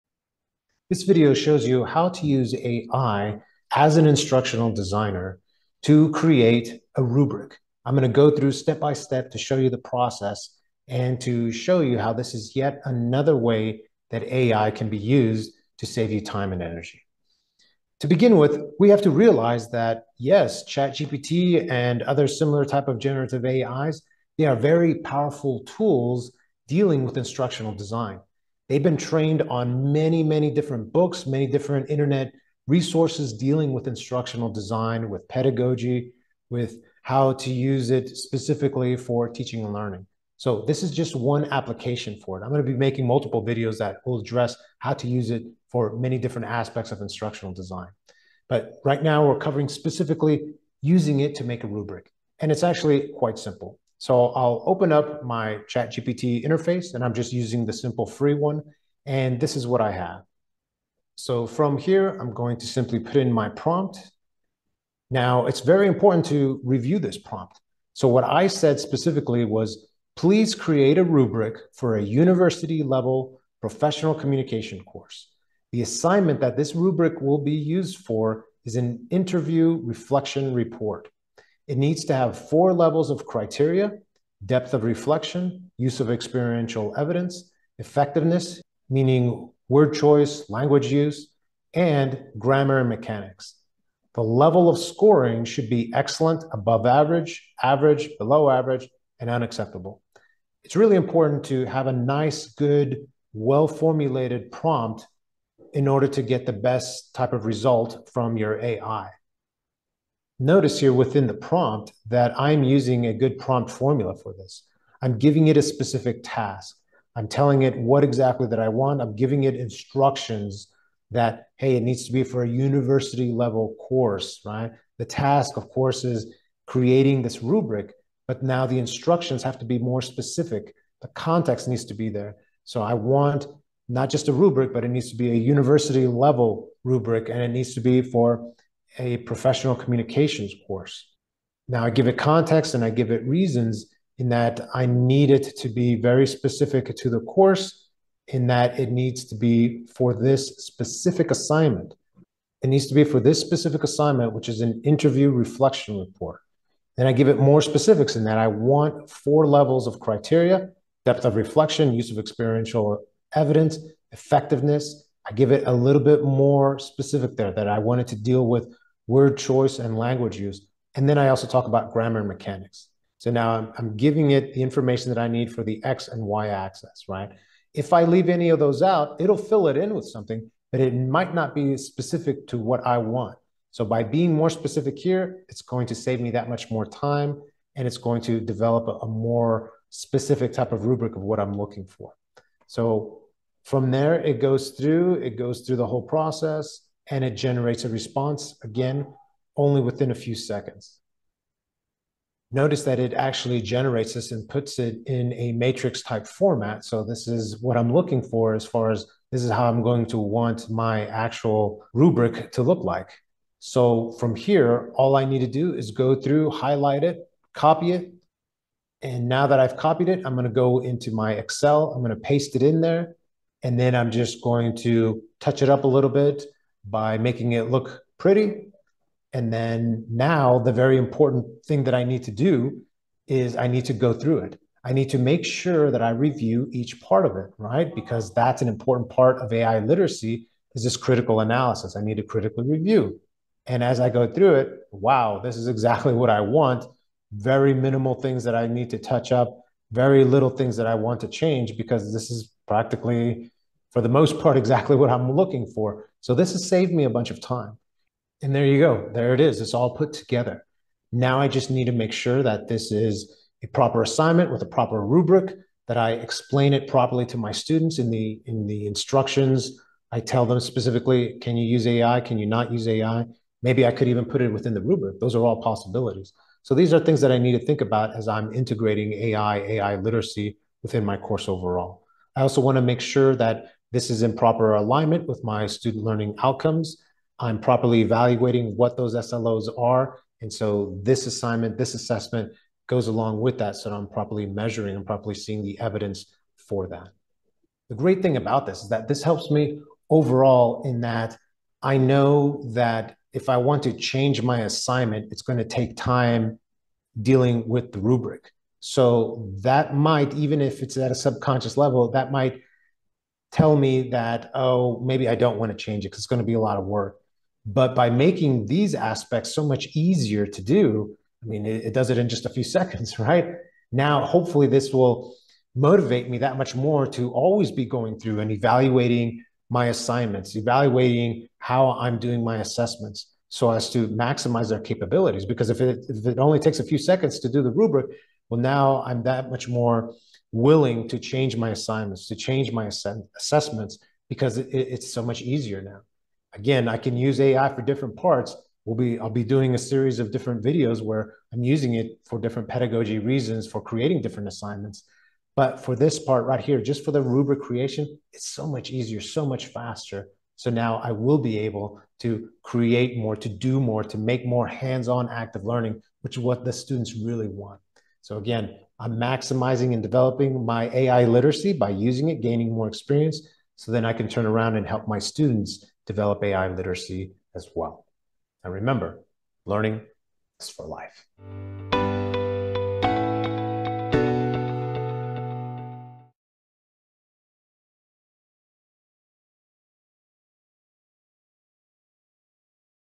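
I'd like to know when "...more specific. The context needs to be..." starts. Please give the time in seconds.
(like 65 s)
129 s.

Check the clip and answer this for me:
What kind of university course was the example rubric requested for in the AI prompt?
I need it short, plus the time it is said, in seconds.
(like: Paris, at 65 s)
professional communication, at 73 s.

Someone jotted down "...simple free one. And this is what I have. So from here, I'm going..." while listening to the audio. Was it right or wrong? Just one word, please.
right.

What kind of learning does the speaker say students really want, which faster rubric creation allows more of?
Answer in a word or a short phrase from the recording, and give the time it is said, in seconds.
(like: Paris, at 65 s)
hands-on active learning, at 364 s.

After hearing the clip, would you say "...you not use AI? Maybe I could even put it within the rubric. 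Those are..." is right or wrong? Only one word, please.
right.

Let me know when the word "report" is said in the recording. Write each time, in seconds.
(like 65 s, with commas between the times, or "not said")
80 s, 155 s.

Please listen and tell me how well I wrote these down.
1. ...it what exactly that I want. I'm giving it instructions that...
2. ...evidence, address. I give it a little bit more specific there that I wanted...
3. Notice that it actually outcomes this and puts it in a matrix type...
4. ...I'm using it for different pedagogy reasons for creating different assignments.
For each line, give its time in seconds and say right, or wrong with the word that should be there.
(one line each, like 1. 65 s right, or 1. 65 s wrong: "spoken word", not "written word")
1. 117 s right
2. 163 s wrong: "effectiveness", not "address"
3. 202 s wrong: "generates", not "outcomes"
4. 351 s right.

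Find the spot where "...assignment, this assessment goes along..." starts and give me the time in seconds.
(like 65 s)
291 s.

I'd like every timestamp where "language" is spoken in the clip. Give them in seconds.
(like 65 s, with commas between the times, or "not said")
90 s, 169 s.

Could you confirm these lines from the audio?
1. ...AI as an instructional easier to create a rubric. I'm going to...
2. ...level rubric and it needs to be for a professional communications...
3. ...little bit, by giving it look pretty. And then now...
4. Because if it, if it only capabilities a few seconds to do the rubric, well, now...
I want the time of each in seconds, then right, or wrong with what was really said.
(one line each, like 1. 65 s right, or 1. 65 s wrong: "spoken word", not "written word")
1. 2 s wrong: "designer", not "easier"
2. 136 s right
3. 225 s wrong: "making", not "giving"
4. 335 s wrong: "takes", not "capabilities".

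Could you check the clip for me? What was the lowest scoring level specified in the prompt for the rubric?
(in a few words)
unacceptable.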